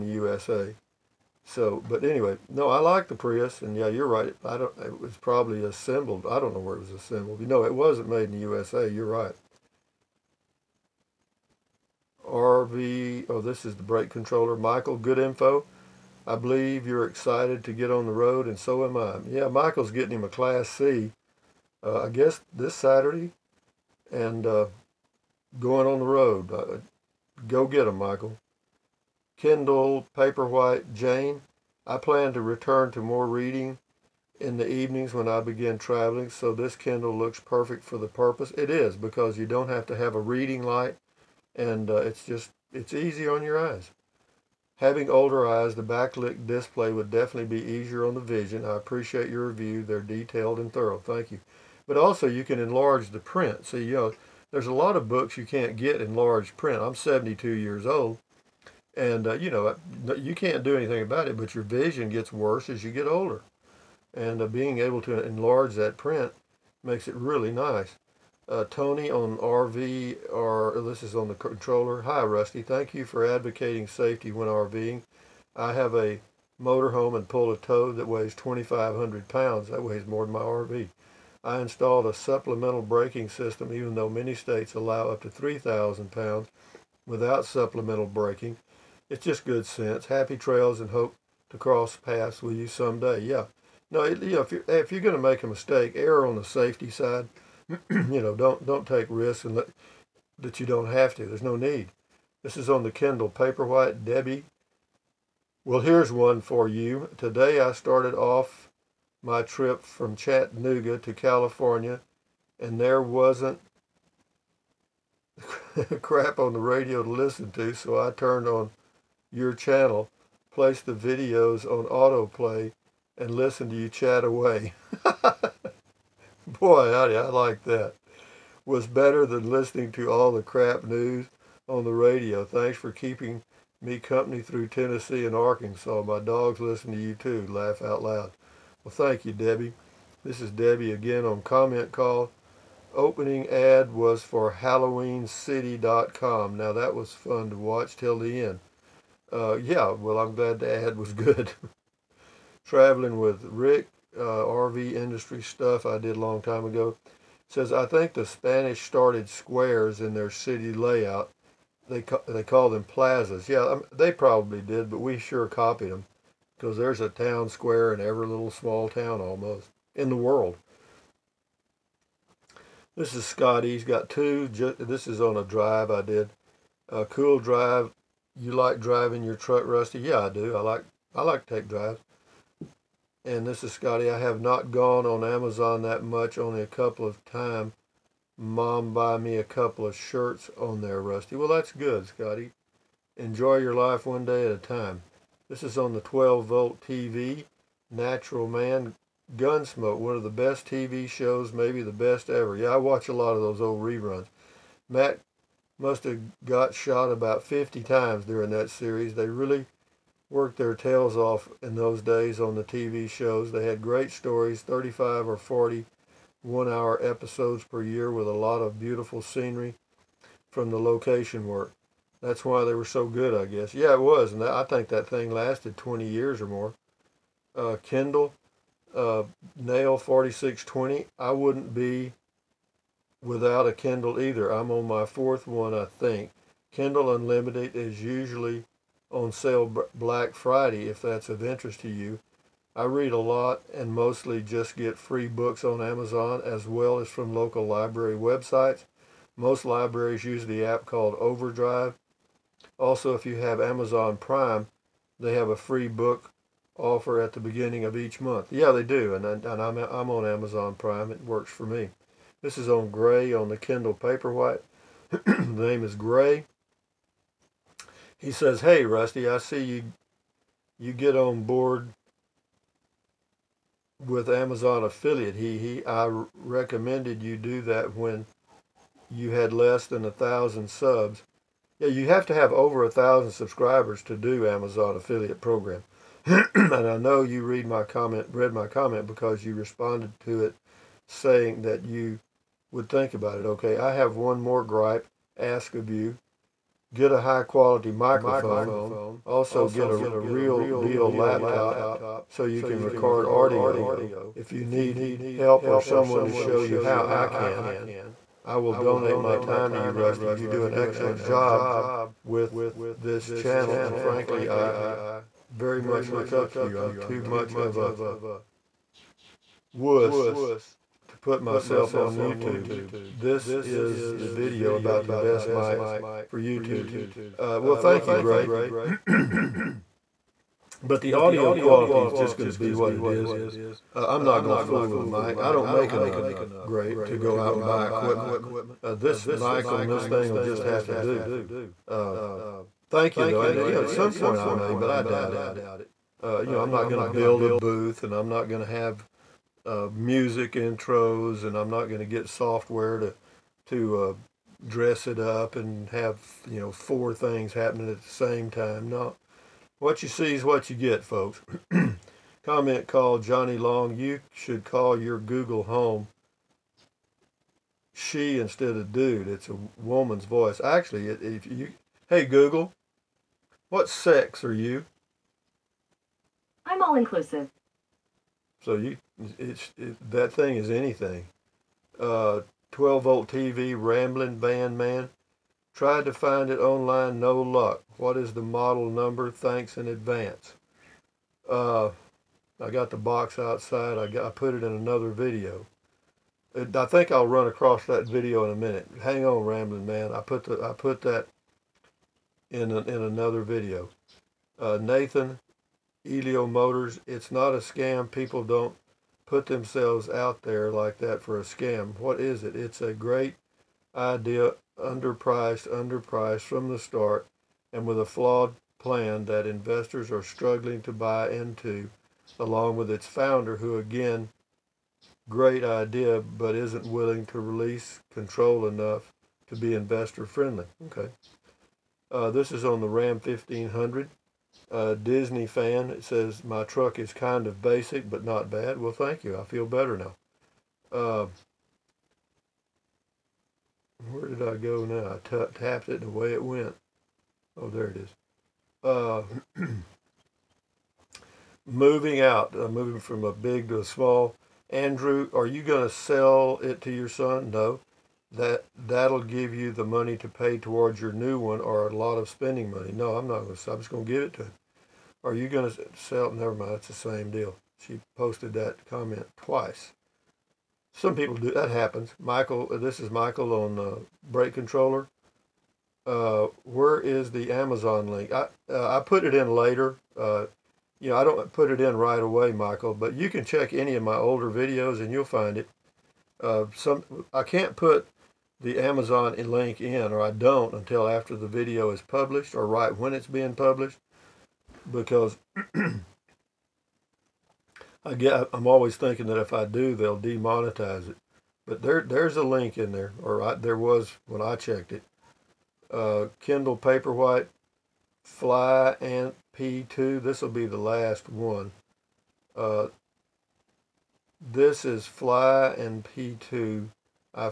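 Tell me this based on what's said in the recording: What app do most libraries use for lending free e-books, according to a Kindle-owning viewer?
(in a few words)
Overdrive.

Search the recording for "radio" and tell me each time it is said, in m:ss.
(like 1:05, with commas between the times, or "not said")
1:56, 2:11.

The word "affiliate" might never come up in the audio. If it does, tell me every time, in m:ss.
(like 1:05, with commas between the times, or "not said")
4:34, 4:44.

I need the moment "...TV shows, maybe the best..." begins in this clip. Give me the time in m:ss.
3:20.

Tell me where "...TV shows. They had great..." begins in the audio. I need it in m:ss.
3:32.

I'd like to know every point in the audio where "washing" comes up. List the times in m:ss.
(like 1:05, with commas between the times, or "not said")
not said.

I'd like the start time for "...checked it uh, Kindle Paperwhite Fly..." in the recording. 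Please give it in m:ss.
8:24.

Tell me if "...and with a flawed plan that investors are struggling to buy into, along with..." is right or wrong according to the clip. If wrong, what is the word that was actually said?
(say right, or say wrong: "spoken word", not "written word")
right.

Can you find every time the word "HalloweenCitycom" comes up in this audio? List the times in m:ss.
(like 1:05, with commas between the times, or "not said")
2:24.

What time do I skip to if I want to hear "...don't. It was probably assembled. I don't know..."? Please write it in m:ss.
0:04.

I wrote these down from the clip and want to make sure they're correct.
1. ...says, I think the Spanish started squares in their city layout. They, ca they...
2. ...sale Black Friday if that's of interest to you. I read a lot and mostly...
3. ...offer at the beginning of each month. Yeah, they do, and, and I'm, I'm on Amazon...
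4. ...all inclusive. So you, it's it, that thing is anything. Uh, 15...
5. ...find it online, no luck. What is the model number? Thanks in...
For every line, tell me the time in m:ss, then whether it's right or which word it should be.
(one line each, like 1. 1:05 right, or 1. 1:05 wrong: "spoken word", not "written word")
1. 2:37 right
2. 3:59 right
3. 4:16 right
4. 6:16 wrong: "12", not "15"
5. 6:26 right.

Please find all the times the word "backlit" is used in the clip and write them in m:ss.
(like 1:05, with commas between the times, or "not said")
0:45.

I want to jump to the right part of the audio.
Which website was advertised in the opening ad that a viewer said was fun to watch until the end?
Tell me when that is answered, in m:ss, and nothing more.
2:24.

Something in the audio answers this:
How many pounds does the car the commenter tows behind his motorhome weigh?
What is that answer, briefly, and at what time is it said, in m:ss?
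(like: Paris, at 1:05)
2,500, at 1:18.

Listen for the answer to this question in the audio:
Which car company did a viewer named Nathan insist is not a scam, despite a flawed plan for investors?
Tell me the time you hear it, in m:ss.
6:46.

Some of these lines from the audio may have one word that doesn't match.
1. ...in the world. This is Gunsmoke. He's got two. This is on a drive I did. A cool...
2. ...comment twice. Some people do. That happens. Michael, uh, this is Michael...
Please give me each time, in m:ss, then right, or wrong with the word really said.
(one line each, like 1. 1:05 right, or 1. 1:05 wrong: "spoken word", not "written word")
1. 2:49 wrong: "Scotty", not "Gunsmoke"
2. 7:48 right.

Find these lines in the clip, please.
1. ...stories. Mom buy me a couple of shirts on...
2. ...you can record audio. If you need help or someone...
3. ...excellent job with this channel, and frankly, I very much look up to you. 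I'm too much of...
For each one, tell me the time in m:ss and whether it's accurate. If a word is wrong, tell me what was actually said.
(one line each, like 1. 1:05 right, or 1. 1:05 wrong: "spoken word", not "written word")
1. 3:07 wrong: "times", not "stories"
2. 5:02 right
3. 5:10 right.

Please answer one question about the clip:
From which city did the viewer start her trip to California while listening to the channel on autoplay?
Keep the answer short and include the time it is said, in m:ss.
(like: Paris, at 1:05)
Chattanooga, at 1:50.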